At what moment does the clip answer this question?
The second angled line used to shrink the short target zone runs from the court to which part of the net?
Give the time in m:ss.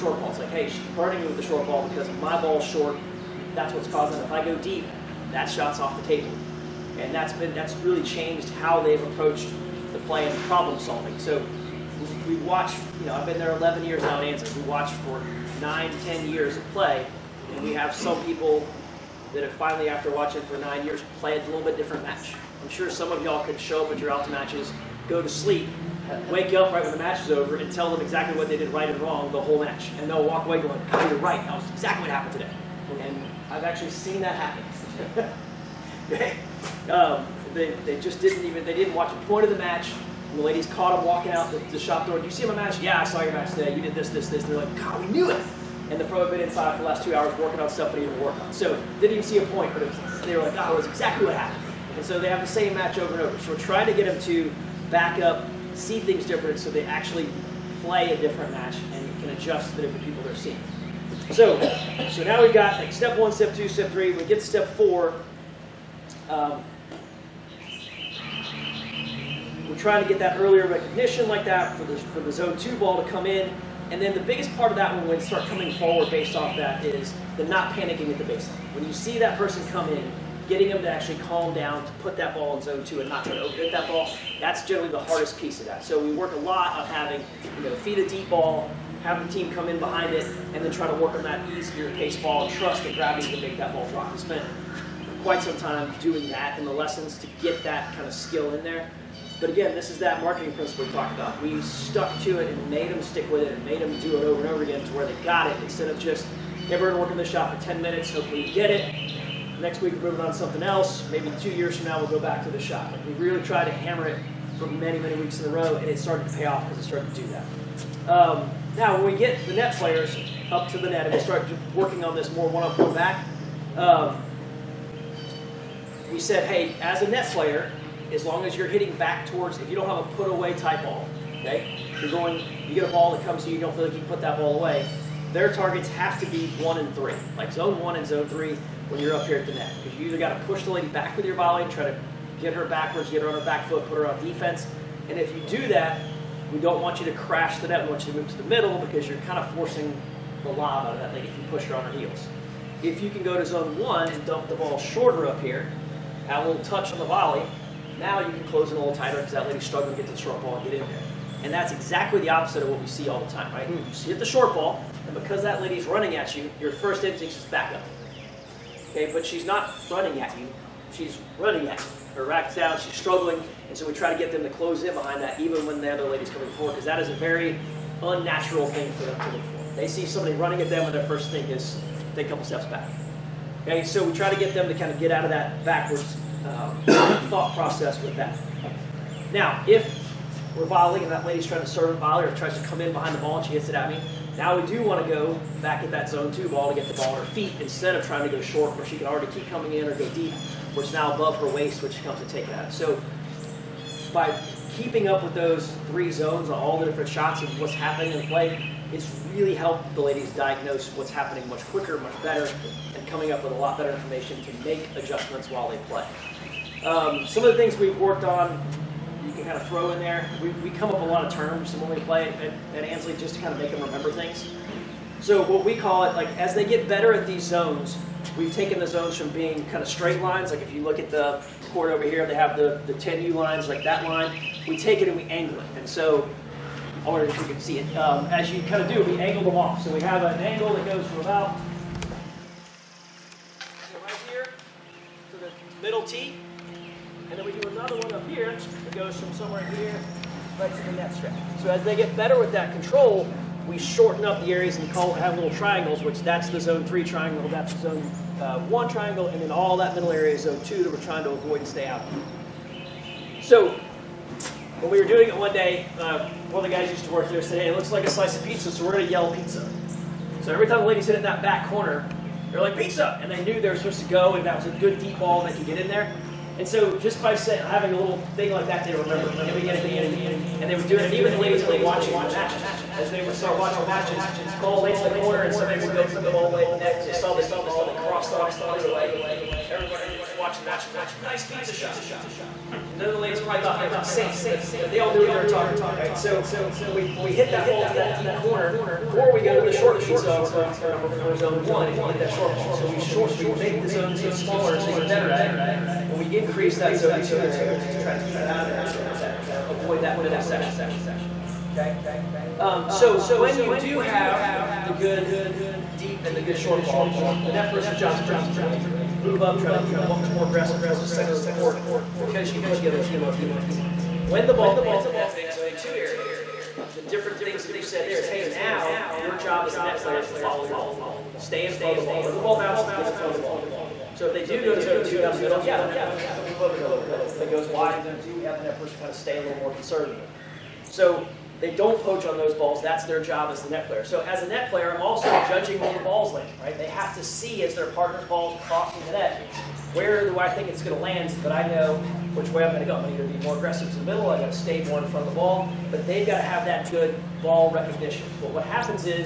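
4:10.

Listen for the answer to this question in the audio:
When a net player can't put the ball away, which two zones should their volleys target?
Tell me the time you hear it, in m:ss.
2:17.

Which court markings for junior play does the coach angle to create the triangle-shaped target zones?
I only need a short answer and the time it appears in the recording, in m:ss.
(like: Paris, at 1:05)
10U lines, at 3:52.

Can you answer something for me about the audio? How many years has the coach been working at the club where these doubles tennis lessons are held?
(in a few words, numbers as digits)
11.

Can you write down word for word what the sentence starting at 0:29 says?
And they'll walk away going, oh, you're right, that was exactly what happened today.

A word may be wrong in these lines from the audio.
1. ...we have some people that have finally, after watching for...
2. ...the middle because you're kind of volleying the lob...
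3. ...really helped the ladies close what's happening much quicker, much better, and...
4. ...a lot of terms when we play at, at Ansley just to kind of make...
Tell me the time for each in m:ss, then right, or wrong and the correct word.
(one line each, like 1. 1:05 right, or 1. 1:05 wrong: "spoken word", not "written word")
1. 0:17 right
2. 2:28 wrong: "forcing", not "volleying"
3. 3:29 wrong: "diagnose", not "close"
4. 3:41 right.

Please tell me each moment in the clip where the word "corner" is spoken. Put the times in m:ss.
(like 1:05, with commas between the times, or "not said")
4:31, 4:45, 4:58.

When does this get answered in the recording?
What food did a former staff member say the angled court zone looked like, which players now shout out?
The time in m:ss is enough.
4:28.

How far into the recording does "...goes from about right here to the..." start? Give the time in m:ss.
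4:00.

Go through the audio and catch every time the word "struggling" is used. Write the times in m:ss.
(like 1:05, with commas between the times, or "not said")
2:39, 2:52.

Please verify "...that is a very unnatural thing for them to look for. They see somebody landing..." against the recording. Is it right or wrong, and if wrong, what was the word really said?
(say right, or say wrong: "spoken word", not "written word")
wrong: "running", not "landing".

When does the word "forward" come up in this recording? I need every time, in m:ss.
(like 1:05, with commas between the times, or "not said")
1:15, 2:56.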